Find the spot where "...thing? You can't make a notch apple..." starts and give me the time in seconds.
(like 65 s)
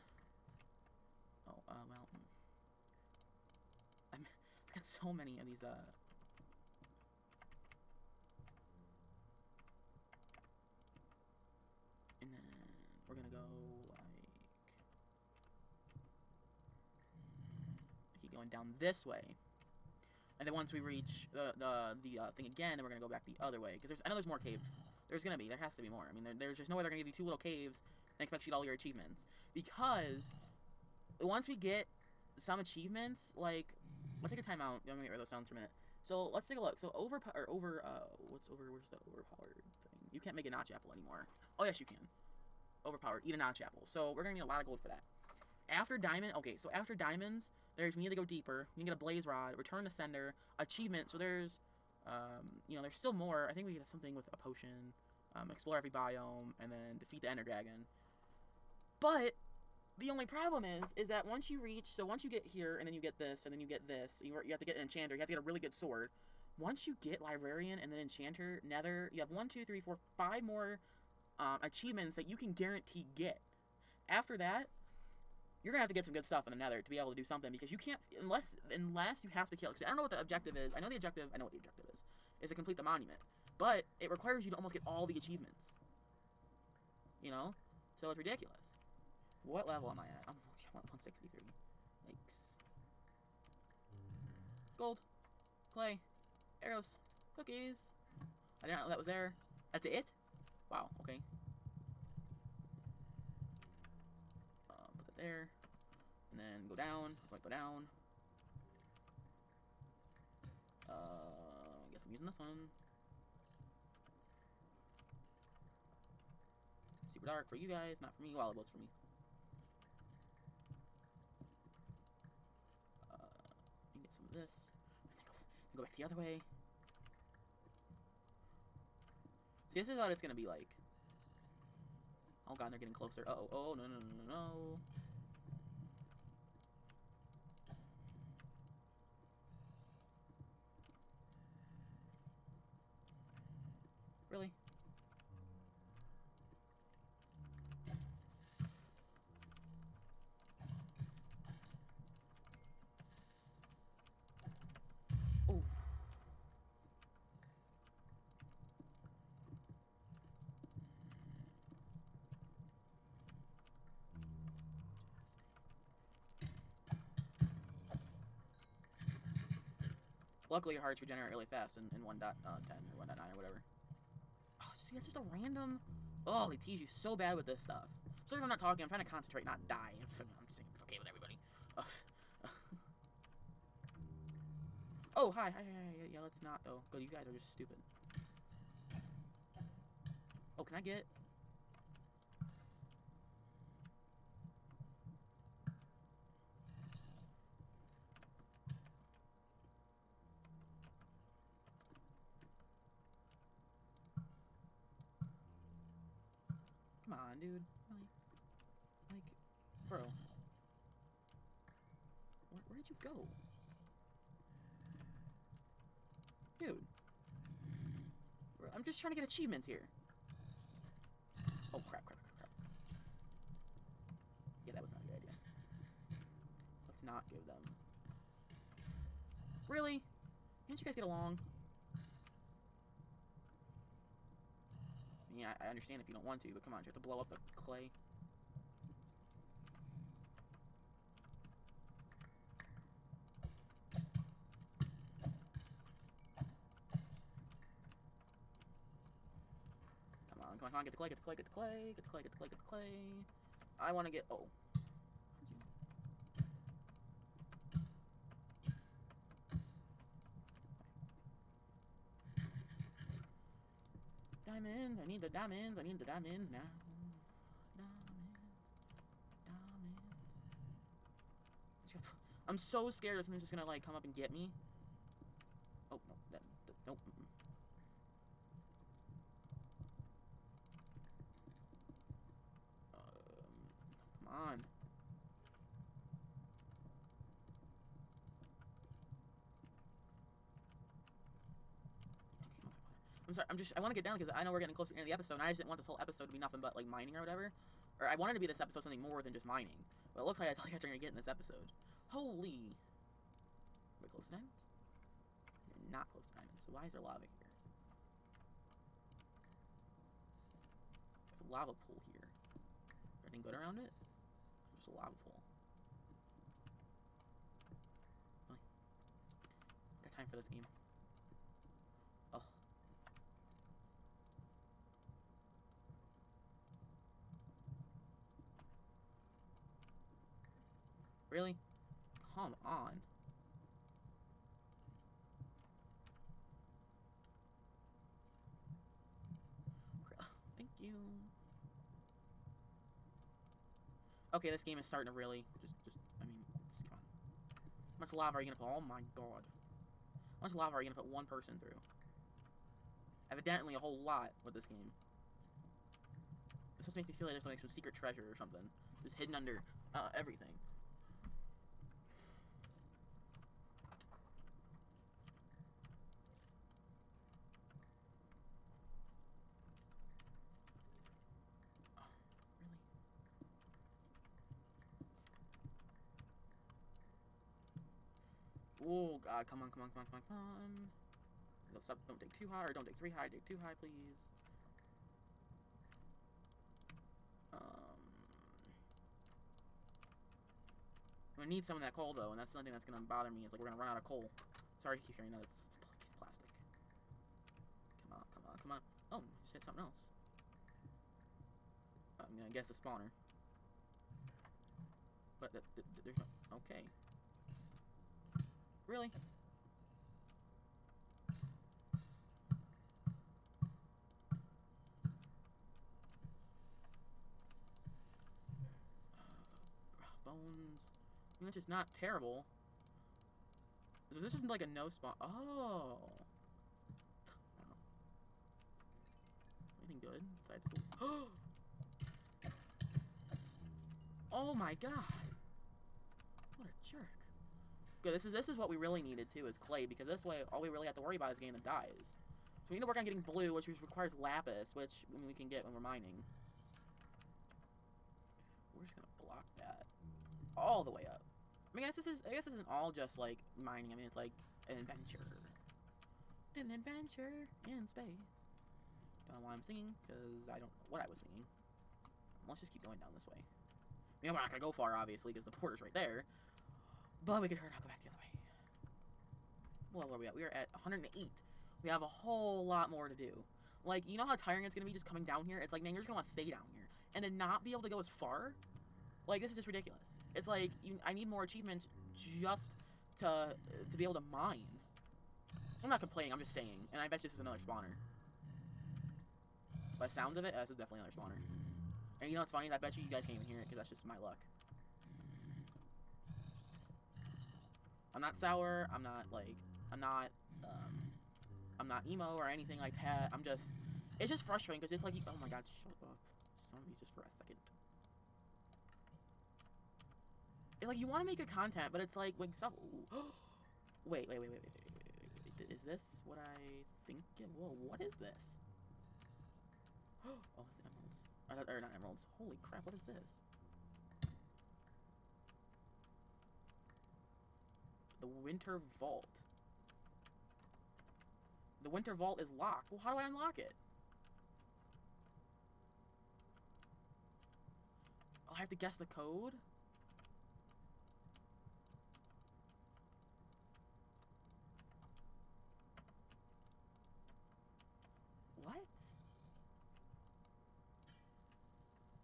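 39 s.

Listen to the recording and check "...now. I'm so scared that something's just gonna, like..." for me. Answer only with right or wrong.
right.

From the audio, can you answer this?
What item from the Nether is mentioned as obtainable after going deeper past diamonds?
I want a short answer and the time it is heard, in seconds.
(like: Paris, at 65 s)
Blaze rod, at 48 s.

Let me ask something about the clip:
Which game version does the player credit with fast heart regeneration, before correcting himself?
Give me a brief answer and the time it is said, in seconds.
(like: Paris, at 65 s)
1.10, at 172 s.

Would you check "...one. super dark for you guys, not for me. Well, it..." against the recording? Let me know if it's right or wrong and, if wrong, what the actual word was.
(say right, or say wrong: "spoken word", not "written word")
right.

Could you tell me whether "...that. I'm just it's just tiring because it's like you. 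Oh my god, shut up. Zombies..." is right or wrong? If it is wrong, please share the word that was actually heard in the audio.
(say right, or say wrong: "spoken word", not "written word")
wrong: "frustrating", not "tiring".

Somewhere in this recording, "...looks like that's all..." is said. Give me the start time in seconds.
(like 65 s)
300 s.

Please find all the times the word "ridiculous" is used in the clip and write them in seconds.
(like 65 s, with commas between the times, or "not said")
88 s, 479 s.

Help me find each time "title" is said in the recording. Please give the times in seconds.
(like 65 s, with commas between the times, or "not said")
not said.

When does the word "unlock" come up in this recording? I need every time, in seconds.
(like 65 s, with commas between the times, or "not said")
533 s.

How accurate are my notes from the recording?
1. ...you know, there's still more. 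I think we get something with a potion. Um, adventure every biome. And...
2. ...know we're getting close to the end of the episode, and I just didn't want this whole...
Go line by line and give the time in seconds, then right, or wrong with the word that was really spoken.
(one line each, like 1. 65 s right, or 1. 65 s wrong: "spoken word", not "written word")
1. 52 s wrong: "explore", not "adventure"
2. 294 s right.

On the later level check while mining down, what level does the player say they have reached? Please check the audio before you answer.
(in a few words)
108.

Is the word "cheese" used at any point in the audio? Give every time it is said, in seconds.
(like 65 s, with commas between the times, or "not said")
not said.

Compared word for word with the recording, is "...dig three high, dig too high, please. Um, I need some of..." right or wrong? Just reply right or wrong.
right.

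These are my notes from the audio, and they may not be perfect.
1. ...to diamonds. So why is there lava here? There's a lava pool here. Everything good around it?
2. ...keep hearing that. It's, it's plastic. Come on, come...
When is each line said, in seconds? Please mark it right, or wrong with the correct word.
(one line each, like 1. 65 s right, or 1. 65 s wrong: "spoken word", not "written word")
1. 306 s right
2. 395 s right.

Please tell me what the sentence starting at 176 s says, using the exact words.
Oh, they tease you so bad with this stuff.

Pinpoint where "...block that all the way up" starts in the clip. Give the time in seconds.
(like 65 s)
449 s.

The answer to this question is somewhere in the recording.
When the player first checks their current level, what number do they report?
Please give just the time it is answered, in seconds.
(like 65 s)
90 s.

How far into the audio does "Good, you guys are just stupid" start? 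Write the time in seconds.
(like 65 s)
186 s.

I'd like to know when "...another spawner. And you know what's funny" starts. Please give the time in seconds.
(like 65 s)
490 s.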